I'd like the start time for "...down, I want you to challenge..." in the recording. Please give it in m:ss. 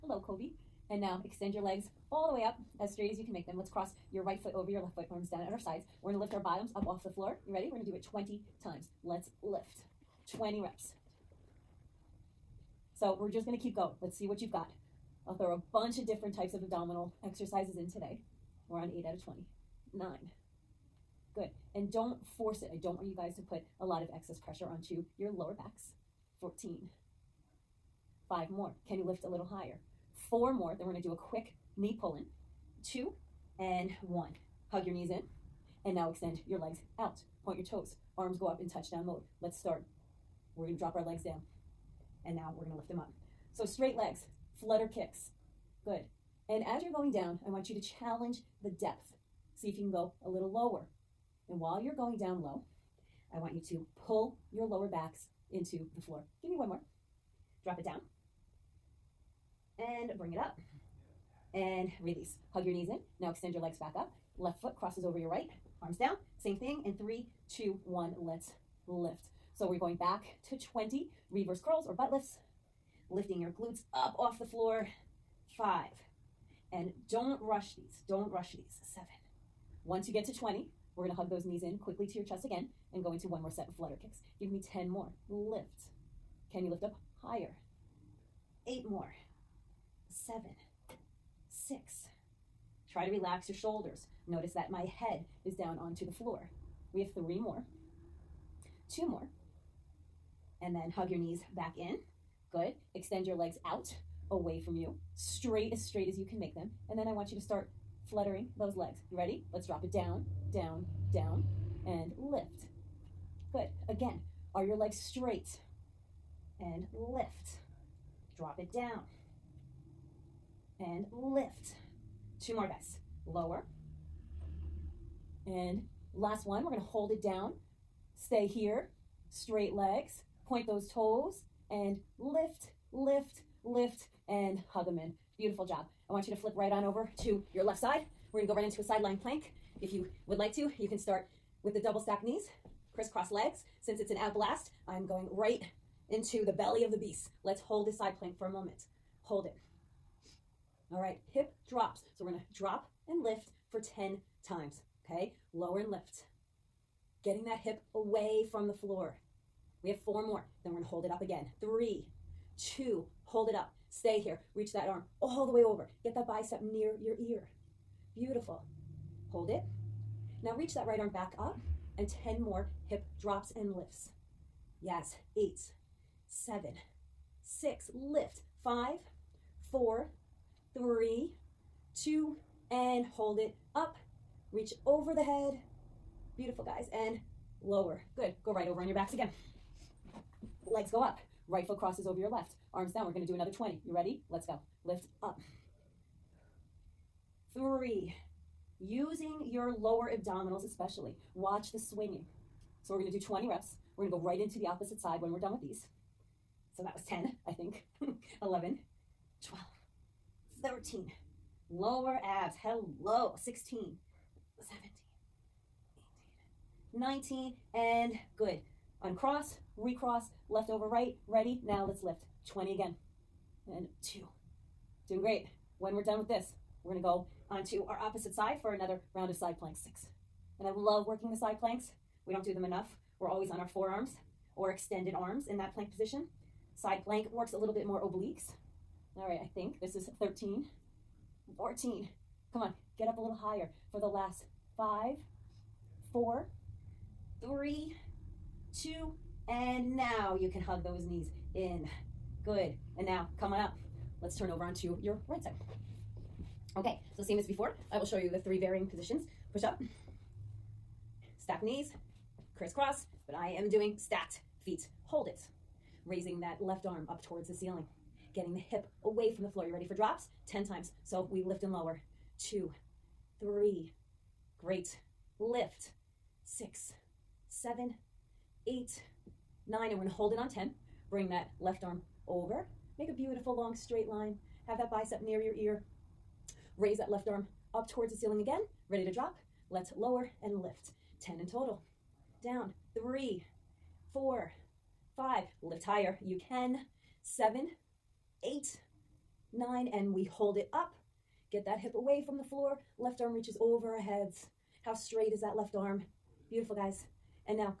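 0:47.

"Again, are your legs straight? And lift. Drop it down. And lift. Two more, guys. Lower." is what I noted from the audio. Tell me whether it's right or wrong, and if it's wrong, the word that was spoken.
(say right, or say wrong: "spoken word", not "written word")
right.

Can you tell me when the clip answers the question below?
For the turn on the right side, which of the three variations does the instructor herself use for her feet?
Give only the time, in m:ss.
4:23.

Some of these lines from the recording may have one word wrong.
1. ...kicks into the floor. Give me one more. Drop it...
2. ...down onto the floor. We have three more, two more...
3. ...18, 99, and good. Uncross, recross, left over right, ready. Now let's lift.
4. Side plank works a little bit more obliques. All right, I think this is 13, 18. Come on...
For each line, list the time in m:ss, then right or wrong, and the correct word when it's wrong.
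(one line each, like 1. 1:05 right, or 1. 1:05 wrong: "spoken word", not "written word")
1. 0:54 wrong: "backs", not "kicks"
2. 1:35 right
3. 3:36 wrong: "19", not "99"
4. 3:56 wrong: "14", not "18".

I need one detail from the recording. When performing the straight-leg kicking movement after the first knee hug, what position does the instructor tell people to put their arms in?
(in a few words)
touchdown mode.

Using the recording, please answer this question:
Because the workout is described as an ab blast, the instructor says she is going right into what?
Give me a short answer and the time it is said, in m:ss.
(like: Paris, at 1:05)
the belly of the beast, at 2:26.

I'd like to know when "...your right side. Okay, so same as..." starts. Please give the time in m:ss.
4:15.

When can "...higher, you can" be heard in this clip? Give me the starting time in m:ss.
4:55.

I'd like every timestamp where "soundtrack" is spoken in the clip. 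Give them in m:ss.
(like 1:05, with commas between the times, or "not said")
not said.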